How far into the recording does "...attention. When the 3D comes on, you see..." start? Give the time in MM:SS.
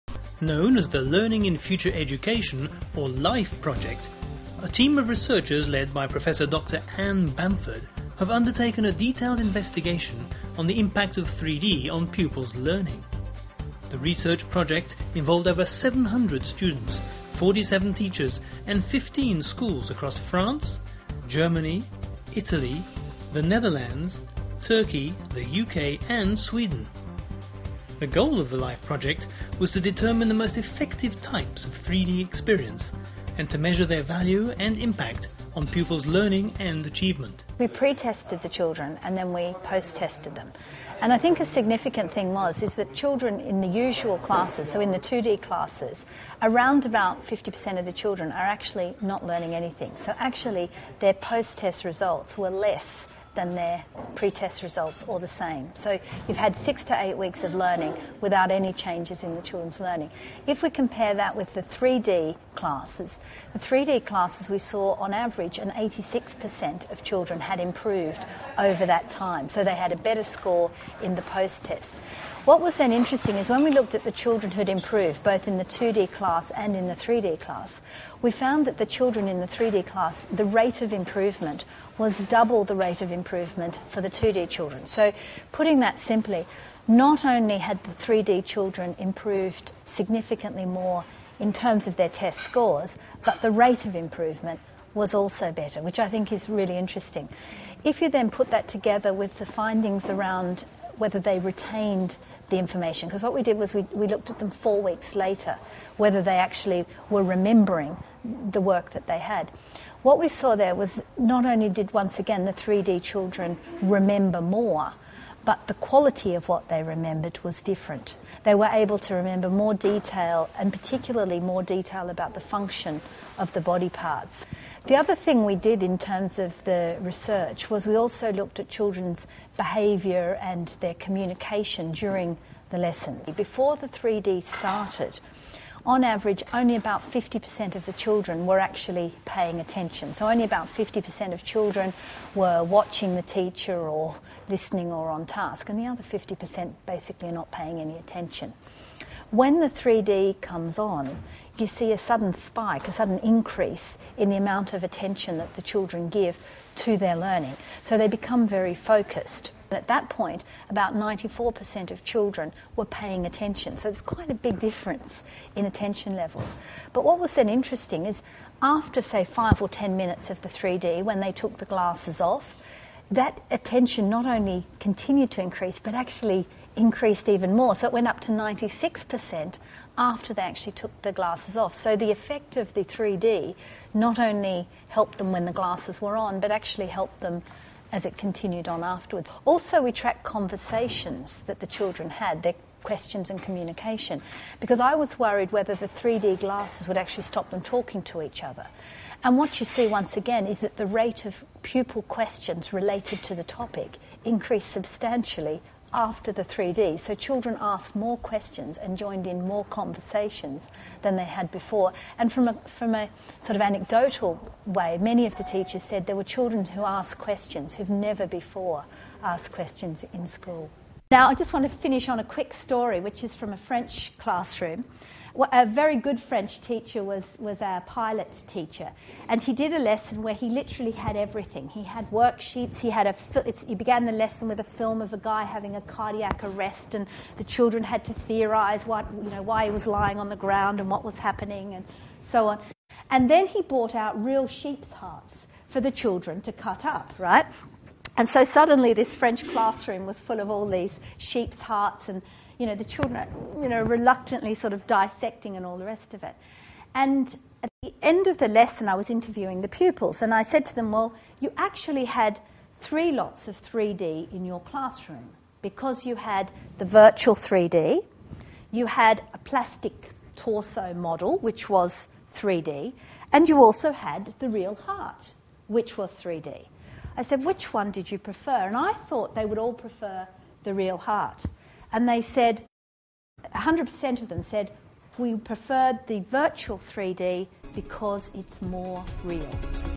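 02:27.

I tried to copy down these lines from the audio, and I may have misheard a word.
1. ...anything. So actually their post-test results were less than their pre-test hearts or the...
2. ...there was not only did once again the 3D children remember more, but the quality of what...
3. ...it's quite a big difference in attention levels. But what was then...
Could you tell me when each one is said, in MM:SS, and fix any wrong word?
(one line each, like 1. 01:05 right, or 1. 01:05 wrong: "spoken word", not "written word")
1. 00:49 wrong: "results", not "hearts"
2. 01:50 right
3. 02:43 right.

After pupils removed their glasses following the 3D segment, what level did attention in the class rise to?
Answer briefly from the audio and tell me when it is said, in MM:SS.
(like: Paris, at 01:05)
96%, at 02:58.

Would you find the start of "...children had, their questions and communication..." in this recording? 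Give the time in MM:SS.
03:11.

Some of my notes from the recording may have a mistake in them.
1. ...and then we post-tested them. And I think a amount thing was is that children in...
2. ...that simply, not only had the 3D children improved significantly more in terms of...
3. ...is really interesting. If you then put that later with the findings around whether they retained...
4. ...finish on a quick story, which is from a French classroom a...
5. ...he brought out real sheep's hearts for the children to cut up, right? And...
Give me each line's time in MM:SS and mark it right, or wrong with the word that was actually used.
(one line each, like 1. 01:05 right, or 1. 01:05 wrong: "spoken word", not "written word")
1. 00:39 wrong: "significant", not "amount"
2. 01:25 right
3. 01:36 wrong: "together", not "later"
4. 03:41 right
5. 04:03 right.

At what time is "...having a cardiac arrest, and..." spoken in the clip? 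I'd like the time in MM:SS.
03:55.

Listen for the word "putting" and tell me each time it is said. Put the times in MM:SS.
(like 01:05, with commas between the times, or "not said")
01:25.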